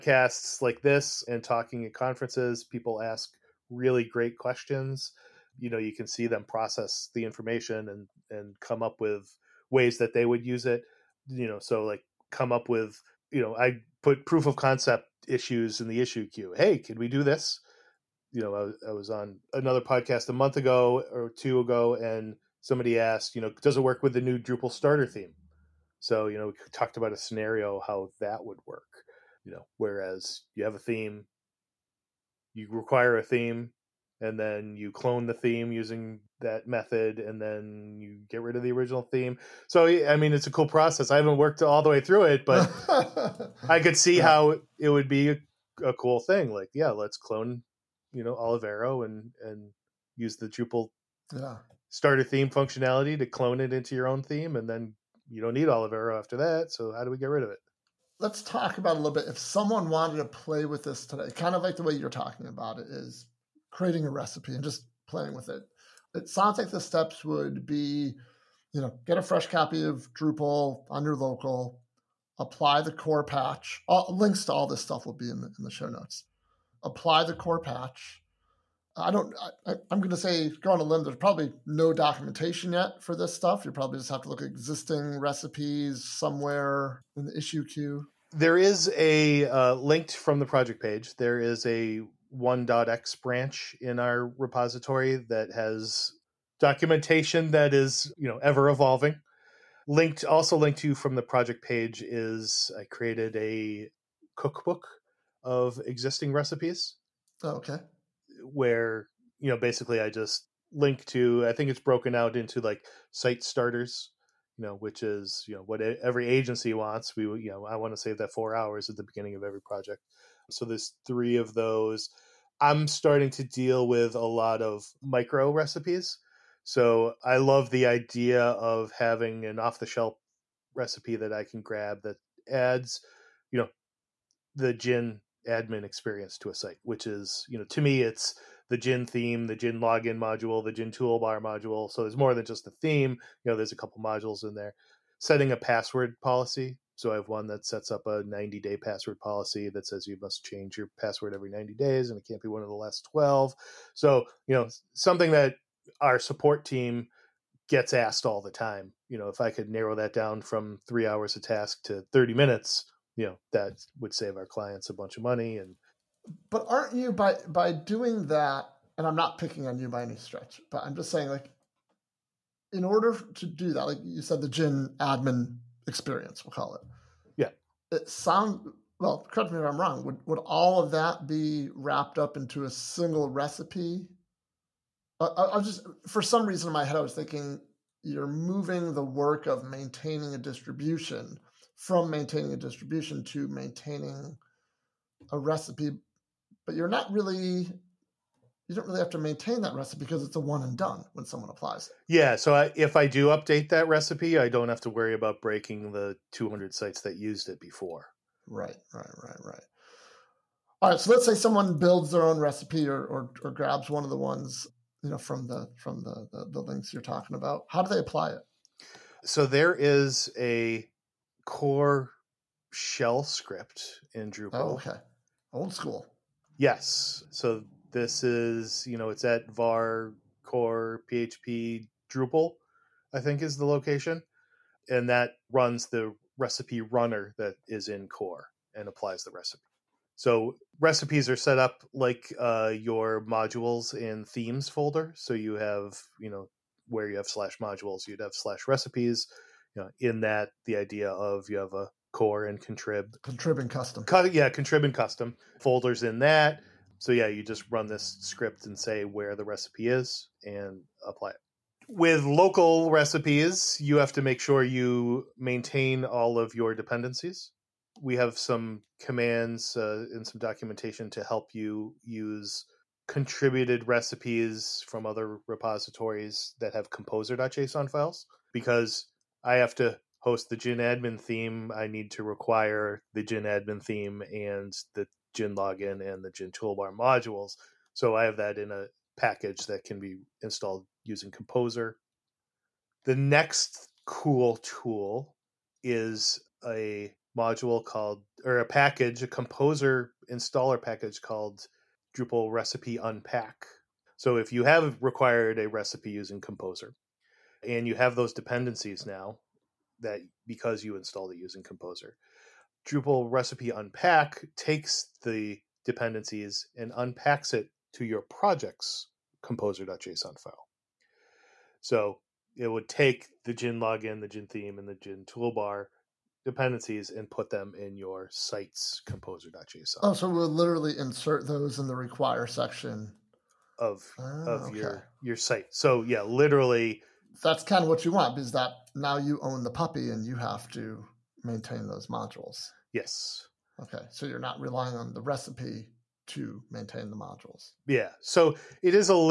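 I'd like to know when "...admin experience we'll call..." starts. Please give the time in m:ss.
2:55.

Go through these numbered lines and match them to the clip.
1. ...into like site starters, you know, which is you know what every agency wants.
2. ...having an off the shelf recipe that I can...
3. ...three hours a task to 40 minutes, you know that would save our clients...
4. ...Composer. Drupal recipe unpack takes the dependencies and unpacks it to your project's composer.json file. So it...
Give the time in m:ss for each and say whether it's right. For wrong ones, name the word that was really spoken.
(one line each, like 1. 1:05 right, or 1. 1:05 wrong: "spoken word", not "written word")
1. 1:52 right
2. 2:08 right
3. 2:40 wrong: "30", not "40"
4. 5:11 right.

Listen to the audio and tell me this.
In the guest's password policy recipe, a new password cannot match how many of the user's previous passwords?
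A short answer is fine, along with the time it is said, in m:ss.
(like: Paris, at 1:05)
12, at 2:33.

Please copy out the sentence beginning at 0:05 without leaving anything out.
You know, you can see them process the information and and come up with ways that they would use it.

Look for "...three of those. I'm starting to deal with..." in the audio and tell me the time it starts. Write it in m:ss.
2:01.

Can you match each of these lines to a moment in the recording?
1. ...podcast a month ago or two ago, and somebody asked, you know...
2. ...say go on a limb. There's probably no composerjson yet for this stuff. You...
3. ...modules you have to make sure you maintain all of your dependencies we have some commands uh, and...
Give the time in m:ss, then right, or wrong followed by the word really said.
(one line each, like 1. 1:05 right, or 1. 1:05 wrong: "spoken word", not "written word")
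1. 0:19 right
2. 1:20 wrong: "documentation", not "composerjson"
3. 4:22 wrong: "recipes", not "modules".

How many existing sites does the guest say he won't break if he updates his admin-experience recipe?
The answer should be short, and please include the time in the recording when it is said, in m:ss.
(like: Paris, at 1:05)
200, at 3:26.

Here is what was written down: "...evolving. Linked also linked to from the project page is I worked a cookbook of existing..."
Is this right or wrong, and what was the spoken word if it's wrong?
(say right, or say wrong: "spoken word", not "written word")
wrong: "created", not "worked".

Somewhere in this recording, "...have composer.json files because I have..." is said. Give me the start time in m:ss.
4:36.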